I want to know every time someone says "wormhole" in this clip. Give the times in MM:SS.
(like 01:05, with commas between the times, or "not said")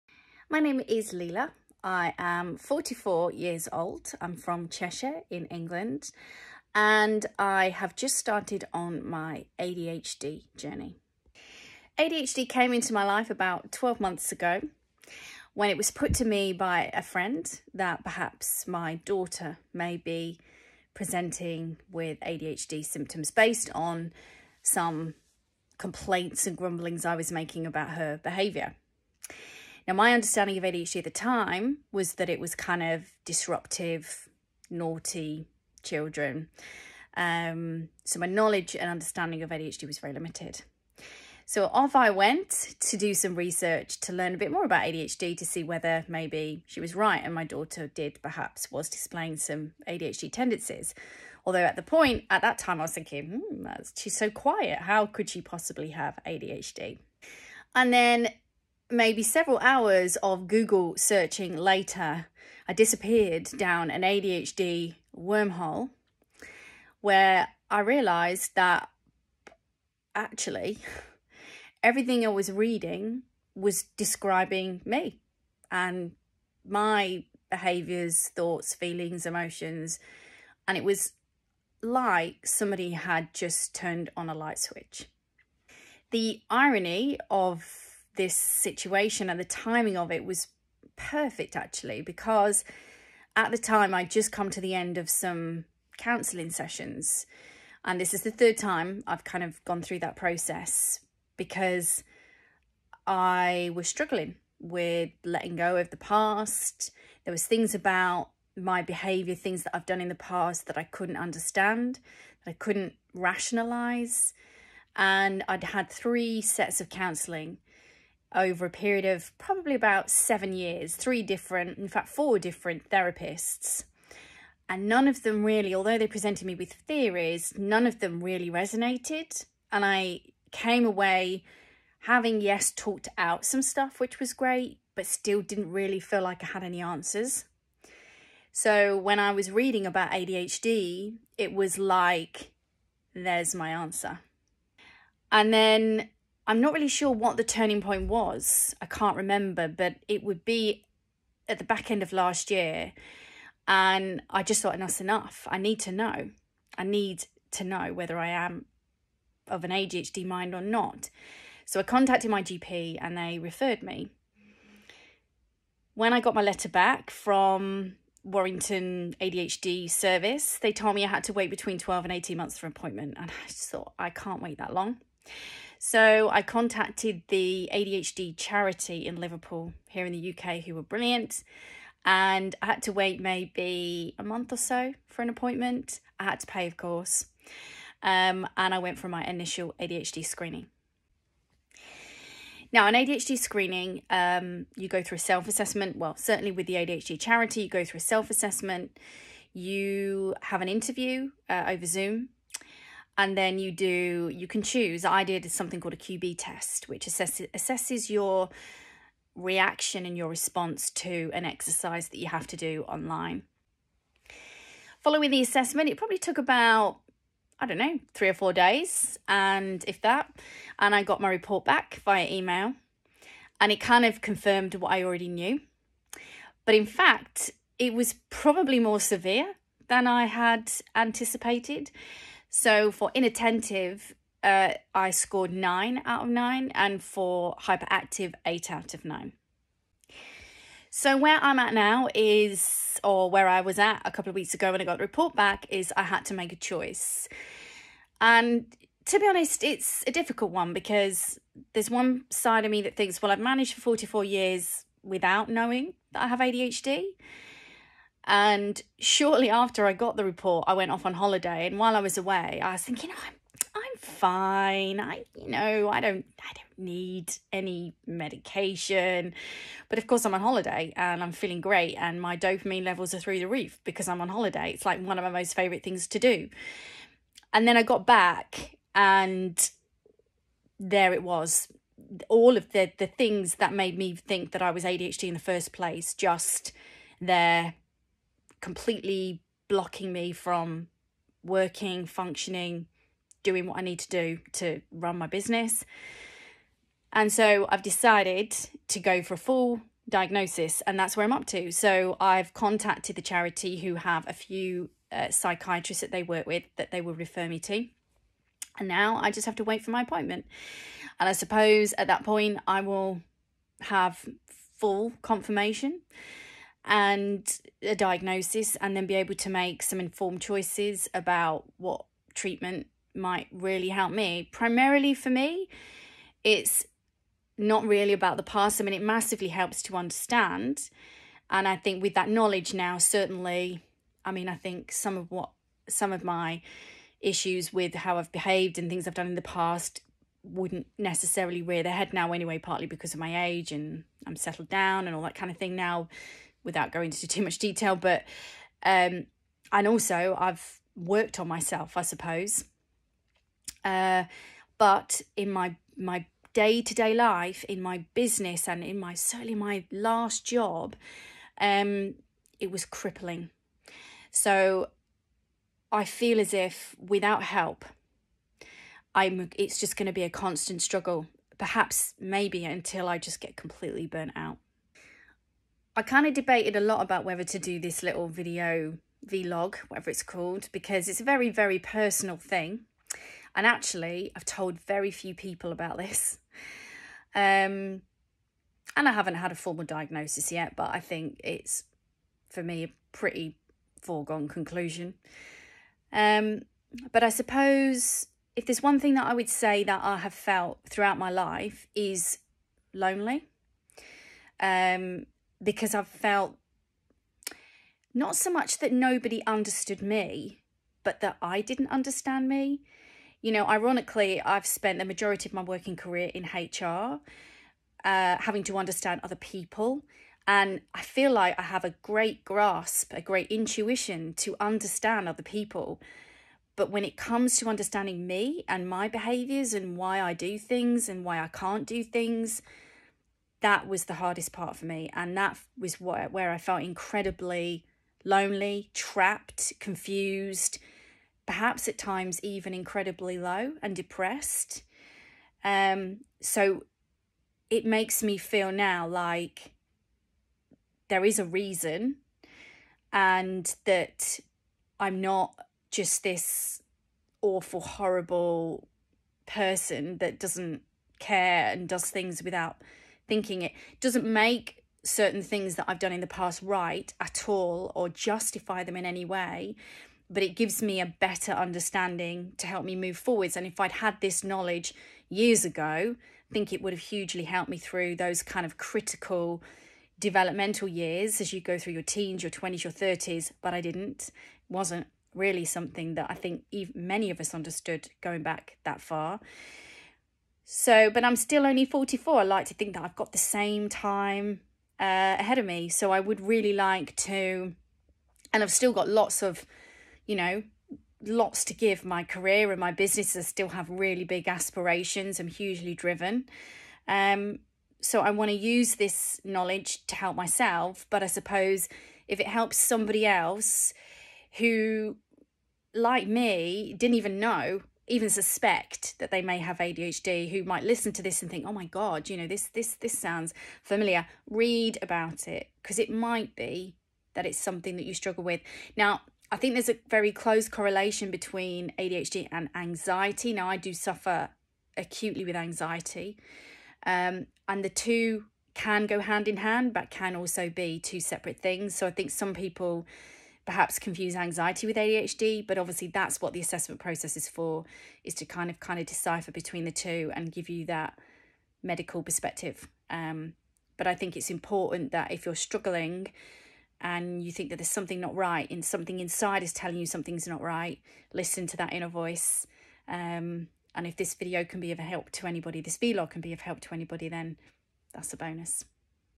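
01:05.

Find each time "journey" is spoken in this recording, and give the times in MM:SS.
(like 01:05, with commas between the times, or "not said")
00:10.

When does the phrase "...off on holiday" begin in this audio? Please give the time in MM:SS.
04:20.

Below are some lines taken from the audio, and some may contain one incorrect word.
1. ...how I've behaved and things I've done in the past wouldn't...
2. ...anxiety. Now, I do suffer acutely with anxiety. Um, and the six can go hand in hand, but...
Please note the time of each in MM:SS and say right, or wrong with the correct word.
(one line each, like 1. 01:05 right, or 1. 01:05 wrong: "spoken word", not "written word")
1. 05:37 right
2. 08:52 wrong: "two", not "six".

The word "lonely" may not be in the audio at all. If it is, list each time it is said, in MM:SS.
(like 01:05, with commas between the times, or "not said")
06:42, 07:18.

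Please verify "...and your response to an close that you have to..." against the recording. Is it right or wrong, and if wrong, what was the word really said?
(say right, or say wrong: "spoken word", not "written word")
wrong: "exercise", not "close".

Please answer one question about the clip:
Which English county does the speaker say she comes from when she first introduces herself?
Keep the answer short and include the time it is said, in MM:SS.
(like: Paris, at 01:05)
Cheshire, at 00:04.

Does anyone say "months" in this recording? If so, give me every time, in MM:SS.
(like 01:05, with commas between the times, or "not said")
00:14, 02:52, 03:04.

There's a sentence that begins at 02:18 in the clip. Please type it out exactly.
So when I was reading about ADHD, it was like, there's my answer.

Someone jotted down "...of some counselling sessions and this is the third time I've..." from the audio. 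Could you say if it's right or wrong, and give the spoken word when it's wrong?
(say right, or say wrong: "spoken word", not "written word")
right.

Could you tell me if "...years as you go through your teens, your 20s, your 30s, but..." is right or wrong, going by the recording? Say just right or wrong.
right.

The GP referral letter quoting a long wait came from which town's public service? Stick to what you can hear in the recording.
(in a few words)
Warrington.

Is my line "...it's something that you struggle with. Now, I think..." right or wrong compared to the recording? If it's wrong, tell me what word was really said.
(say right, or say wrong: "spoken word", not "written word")
right.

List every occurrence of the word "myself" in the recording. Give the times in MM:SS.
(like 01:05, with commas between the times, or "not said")
05:51, 08:30.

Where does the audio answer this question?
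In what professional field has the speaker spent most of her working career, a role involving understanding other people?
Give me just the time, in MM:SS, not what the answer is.
06:56.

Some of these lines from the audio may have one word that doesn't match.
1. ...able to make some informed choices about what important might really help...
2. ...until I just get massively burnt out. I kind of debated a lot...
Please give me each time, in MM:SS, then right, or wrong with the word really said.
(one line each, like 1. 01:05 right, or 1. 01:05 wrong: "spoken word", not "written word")
1. 05:19 wrong: "treatment", not "important"
2. 06:12 wrong: "completely", not "massively".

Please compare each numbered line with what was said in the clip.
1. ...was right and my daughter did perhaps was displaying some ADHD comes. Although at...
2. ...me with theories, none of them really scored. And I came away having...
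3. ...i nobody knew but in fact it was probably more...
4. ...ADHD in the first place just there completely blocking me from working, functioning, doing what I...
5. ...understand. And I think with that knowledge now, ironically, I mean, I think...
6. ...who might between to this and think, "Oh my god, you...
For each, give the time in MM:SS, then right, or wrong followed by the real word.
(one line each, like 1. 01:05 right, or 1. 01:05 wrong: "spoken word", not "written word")
1. 00:46 wrong: "tendencies", not "comes"
2. 02:06 wrong: "resonated", not "scored"
3. 03:44 wrong: "already", not "nobody"
4. 04:44 right
5. 05:29 wrong: "certainly", not "ironically"
6. 08:40 wrong: "listen", not "between".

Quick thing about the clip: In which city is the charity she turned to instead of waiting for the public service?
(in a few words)
Liverpool.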